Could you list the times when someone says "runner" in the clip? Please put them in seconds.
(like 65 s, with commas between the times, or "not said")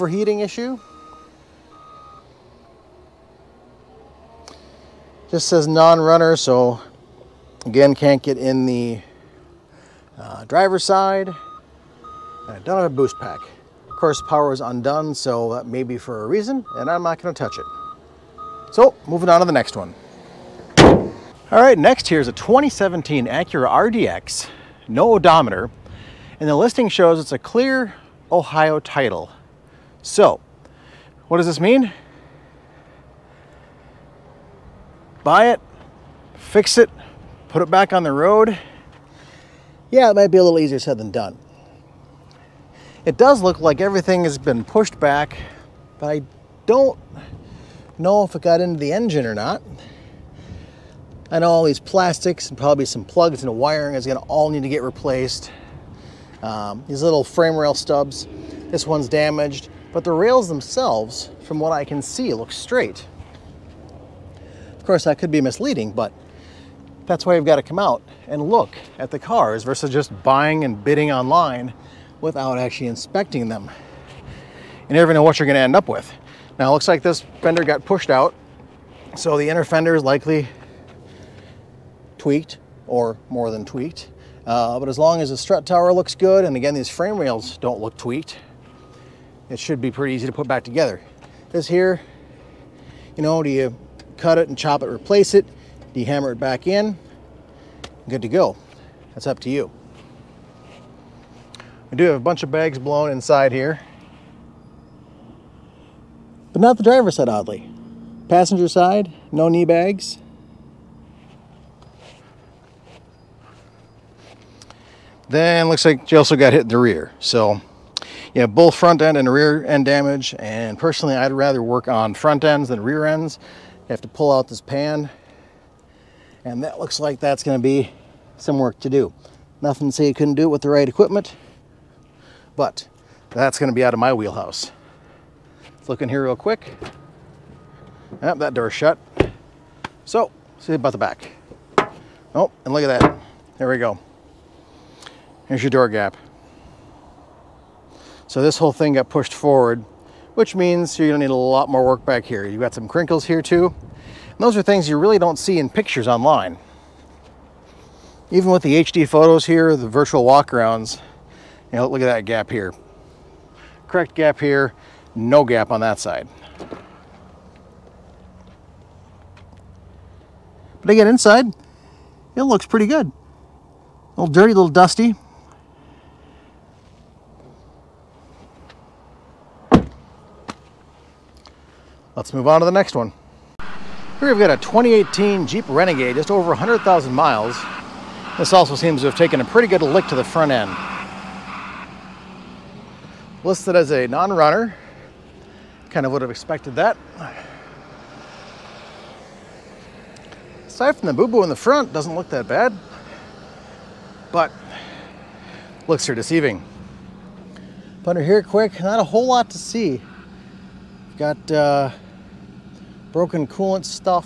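5 s, 194 s.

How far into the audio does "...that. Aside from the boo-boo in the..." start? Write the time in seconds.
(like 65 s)
196 s.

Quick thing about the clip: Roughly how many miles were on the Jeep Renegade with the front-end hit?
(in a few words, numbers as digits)
100,000.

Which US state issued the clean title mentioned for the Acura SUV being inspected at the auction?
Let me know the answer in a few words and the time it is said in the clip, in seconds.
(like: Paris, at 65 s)
Ohio, at 28 s.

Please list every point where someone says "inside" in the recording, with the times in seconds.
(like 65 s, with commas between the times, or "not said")
103 s, 171 s.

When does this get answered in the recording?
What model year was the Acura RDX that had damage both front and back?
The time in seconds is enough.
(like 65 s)
22 s.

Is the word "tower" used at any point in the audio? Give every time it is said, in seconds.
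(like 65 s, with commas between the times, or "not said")
85 s.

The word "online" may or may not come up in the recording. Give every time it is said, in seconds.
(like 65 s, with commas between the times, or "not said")
71 s, 156 s.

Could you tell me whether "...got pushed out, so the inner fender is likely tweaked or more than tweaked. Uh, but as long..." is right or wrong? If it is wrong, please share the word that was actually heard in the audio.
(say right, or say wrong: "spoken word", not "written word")
right.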